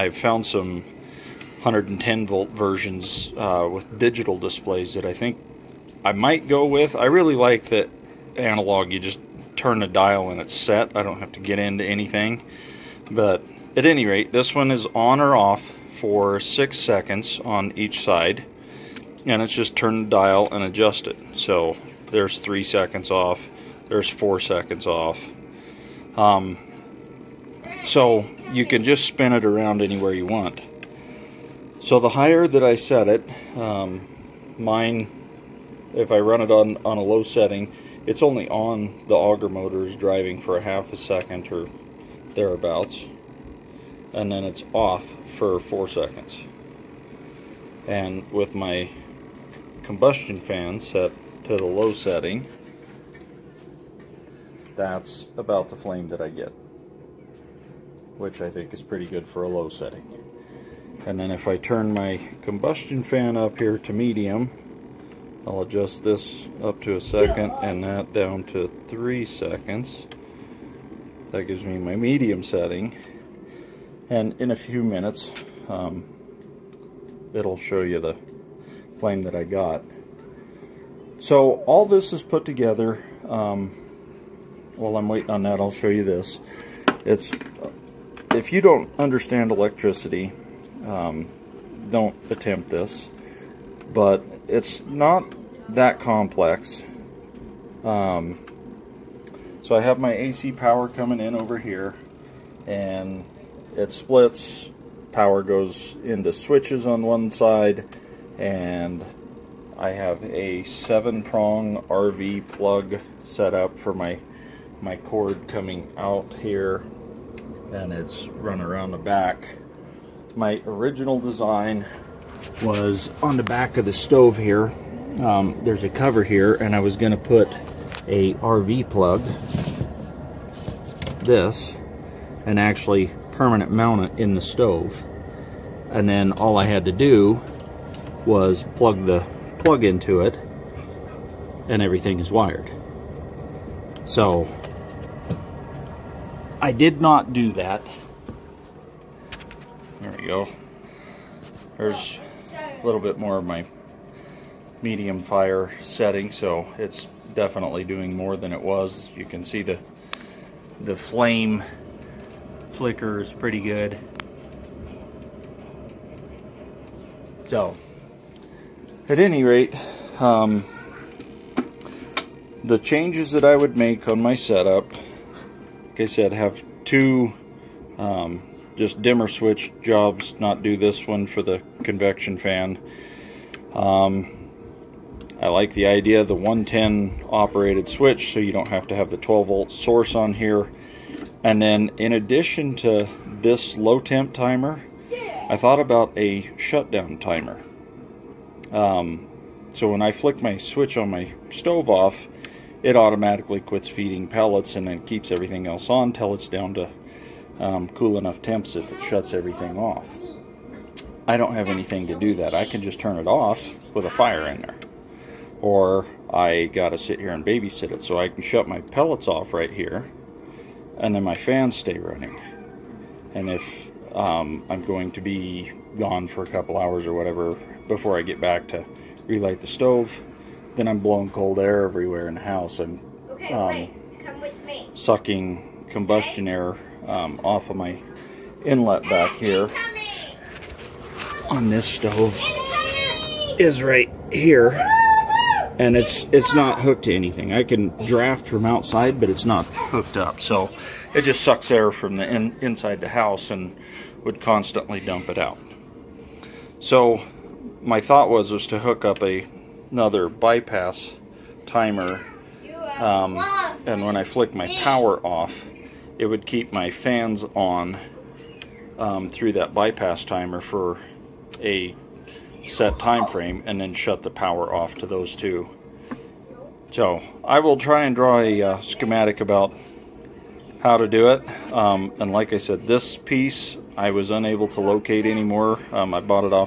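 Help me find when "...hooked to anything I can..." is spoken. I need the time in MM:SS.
04:06.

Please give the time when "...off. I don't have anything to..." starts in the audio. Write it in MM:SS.
03:29.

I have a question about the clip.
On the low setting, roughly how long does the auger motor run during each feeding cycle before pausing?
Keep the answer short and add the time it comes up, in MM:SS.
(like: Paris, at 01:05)
half a second, at 00:40.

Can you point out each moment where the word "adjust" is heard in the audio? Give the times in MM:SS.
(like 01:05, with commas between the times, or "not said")
00:20, 01:05.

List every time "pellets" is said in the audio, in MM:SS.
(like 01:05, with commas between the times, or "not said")
03:24, 03:38.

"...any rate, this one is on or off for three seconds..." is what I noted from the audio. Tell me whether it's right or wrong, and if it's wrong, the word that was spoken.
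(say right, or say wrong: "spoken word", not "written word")
wrong: "six", not "three".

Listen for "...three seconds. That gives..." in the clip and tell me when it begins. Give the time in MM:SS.
01:08.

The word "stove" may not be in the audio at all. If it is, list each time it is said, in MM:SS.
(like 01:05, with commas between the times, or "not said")
02:03, 02:14, 03:21, 03:49, 04:01.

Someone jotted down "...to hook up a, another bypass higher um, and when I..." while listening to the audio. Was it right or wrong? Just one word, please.
wrong.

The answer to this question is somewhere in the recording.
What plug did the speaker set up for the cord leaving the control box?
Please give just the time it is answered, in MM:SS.
01:50.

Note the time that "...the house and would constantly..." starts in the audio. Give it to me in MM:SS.
04:12.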